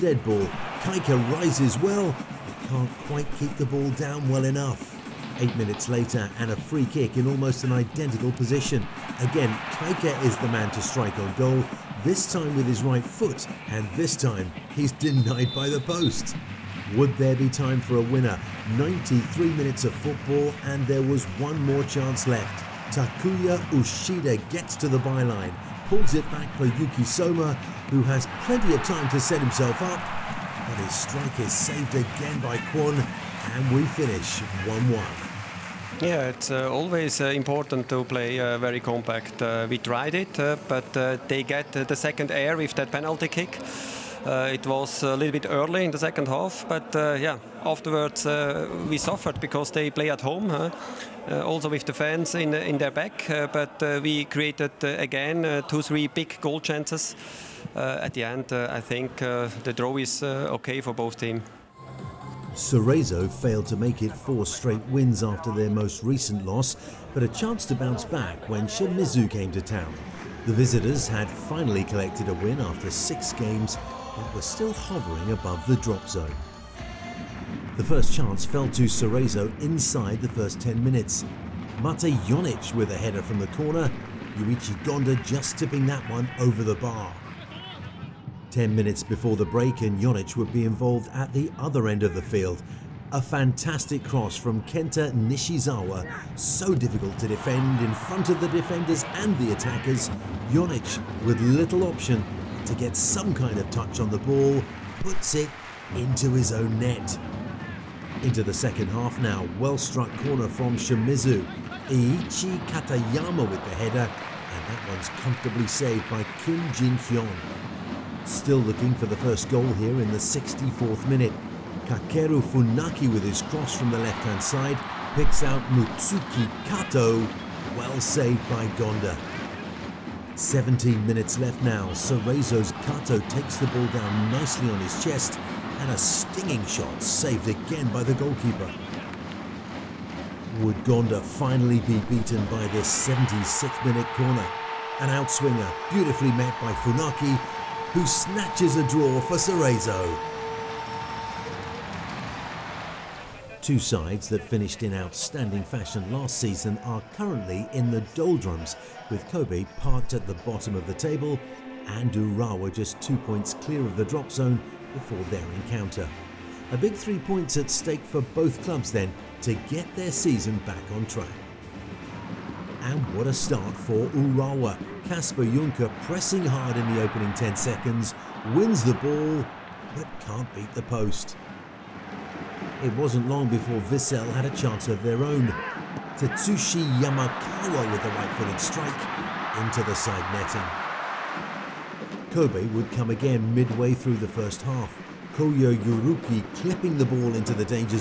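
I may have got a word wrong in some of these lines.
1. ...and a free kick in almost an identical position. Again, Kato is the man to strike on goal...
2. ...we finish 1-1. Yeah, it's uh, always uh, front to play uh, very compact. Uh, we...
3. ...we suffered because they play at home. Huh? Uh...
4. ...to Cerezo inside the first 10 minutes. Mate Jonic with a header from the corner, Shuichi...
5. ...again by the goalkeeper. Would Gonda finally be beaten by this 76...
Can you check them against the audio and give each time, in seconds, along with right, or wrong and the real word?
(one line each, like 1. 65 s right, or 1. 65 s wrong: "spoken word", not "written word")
1. 6 s wrong: "Kaika", not "Kato"
2. 33 s wrong: "important", not "front"
3. 48 s right
4. 78 s right
5. 137 s right.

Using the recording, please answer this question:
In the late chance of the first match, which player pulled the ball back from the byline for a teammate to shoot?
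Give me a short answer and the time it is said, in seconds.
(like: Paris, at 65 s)
Takuya Uchida, at 22 s.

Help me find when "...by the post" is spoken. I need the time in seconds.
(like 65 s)
15 s.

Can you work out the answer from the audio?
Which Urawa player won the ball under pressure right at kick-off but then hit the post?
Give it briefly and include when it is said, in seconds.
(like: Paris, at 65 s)
Kasper Juncker, at 175 s.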